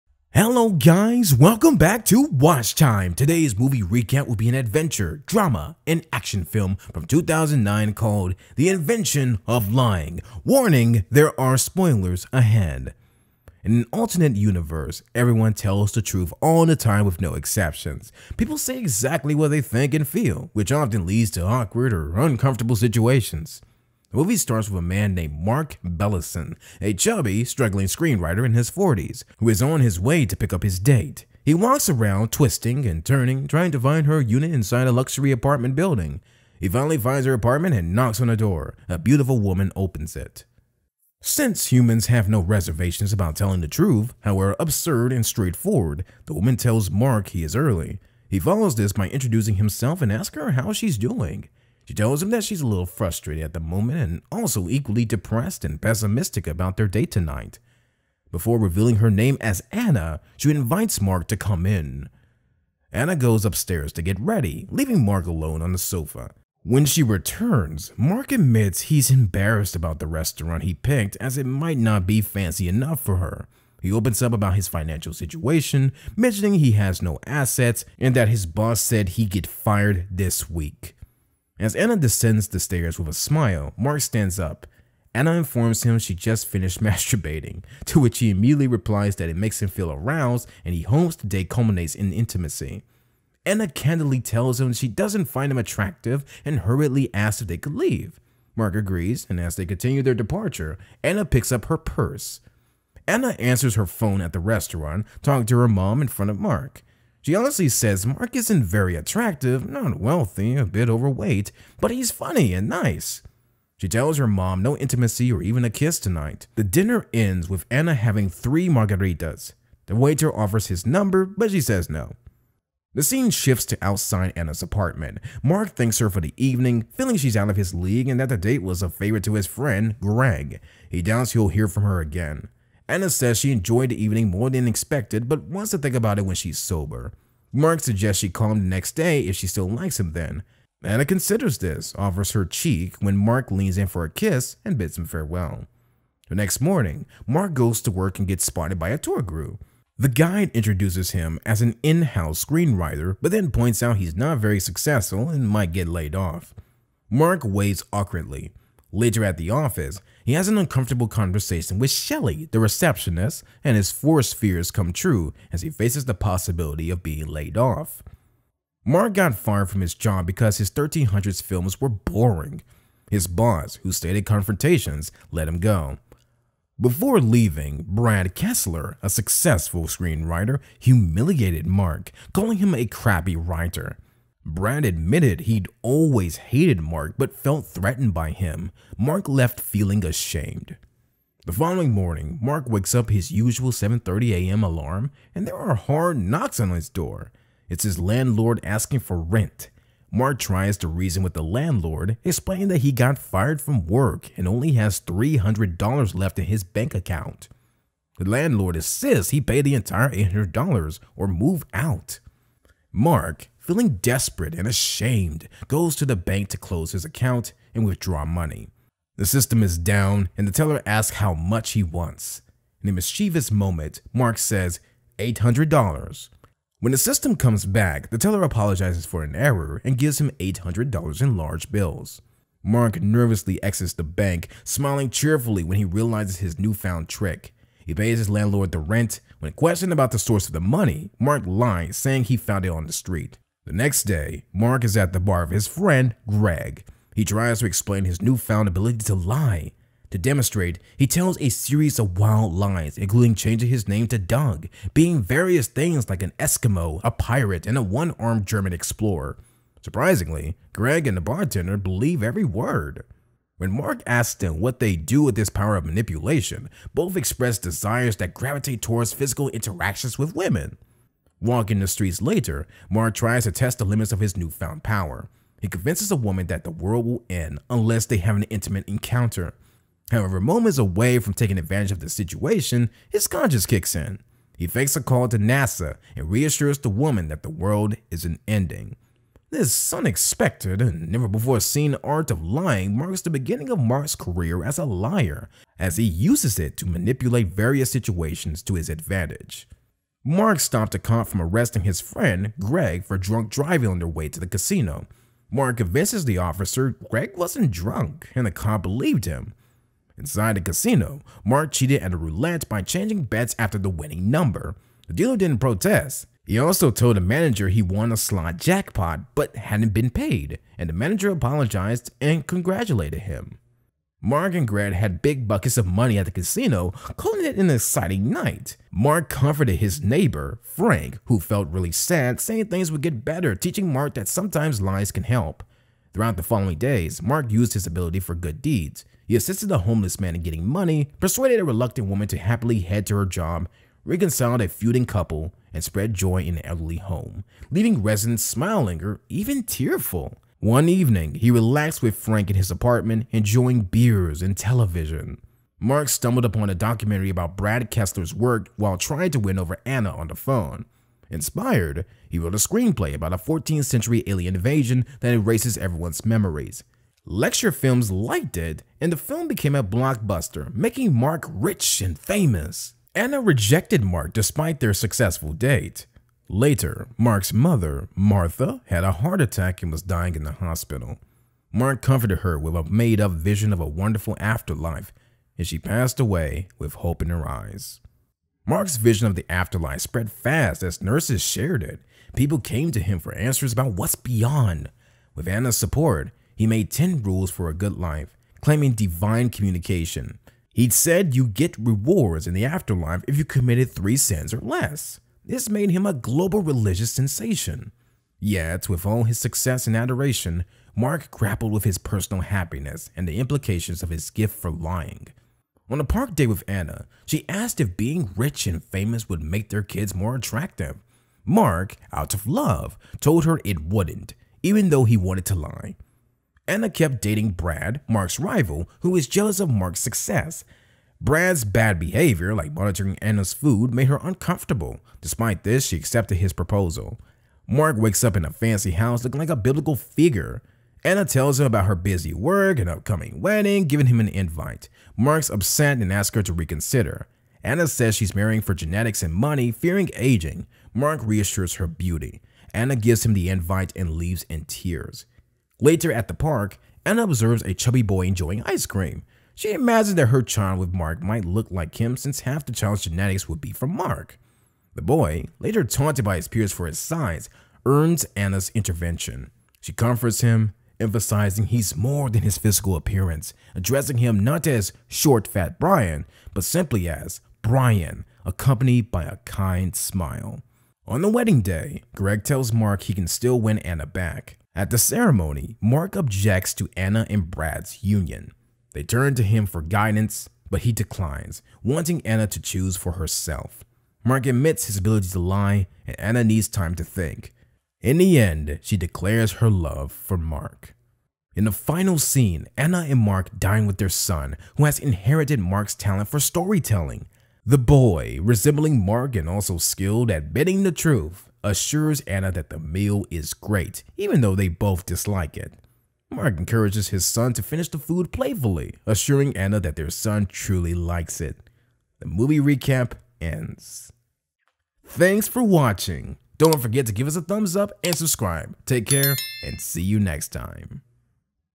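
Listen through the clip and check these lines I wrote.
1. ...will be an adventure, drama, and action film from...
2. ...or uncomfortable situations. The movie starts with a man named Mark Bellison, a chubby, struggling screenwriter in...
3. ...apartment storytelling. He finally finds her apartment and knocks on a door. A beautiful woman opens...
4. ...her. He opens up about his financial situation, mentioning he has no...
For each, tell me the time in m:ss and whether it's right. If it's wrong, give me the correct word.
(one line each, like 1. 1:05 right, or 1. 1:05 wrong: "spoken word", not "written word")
1. 0:04 right
2. 0:21 right
3. 0:35 wrong: "building", not "storytelling"
4. 1:13 right.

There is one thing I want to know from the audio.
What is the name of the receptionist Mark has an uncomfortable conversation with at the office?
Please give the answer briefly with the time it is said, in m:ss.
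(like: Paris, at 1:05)
Shelly, at 2:41.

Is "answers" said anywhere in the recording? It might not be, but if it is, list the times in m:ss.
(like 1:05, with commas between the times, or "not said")
1:43, 6:33.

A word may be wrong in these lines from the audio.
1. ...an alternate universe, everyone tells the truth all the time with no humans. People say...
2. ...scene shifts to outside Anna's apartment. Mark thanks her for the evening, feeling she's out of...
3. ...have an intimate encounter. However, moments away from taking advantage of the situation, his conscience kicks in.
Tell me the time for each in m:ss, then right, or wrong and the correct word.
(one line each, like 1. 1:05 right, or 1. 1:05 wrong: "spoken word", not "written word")
1. 0:13 wrong: "exceptions", not "humans"
2. 2:03 right
3. 4:38 right.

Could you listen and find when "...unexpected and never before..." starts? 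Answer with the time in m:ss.
4:49.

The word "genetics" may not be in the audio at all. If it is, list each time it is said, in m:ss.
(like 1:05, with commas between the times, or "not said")
7:28, 7:43.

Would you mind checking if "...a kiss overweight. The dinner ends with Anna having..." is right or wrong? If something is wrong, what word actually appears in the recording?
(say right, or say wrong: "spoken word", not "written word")
wrong: "tonight", not "overweight".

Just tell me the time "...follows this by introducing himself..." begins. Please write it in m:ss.
0:48.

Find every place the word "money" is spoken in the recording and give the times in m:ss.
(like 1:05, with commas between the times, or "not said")
3:38, 4:00, 5:25, 5:40, 7:29.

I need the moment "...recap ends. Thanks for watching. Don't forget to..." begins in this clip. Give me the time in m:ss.
8:42.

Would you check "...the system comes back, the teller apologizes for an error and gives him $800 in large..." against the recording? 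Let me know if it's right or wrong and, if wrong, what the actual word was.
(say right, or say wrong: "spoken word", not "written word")
right.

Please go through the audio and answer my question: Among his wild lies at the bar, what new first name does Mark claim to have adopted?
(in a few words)
Doug.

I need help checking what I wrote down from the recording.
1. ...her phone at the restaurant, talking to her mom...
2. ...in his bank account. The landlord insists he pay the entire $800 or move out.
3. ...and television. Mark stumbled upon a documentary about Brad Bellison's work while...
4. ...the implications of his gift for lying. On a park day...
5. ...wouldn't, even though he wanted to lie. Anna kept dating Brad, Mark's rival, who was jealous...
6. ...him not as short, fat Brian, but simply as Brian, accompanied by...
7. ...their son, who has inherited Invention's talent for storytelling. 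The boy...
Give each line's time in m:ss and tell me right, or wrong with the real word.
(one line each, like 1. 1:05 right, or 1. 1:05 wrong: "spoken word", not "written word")
1. 1:43 right
2. 3:26 right
3. 5:54 wrong: "Kessler", not "Bellison"
4. 6:53 right
5. 7:03 right
6. 7:54 right
7. 8:23 wrong: "Mark", not "Invention".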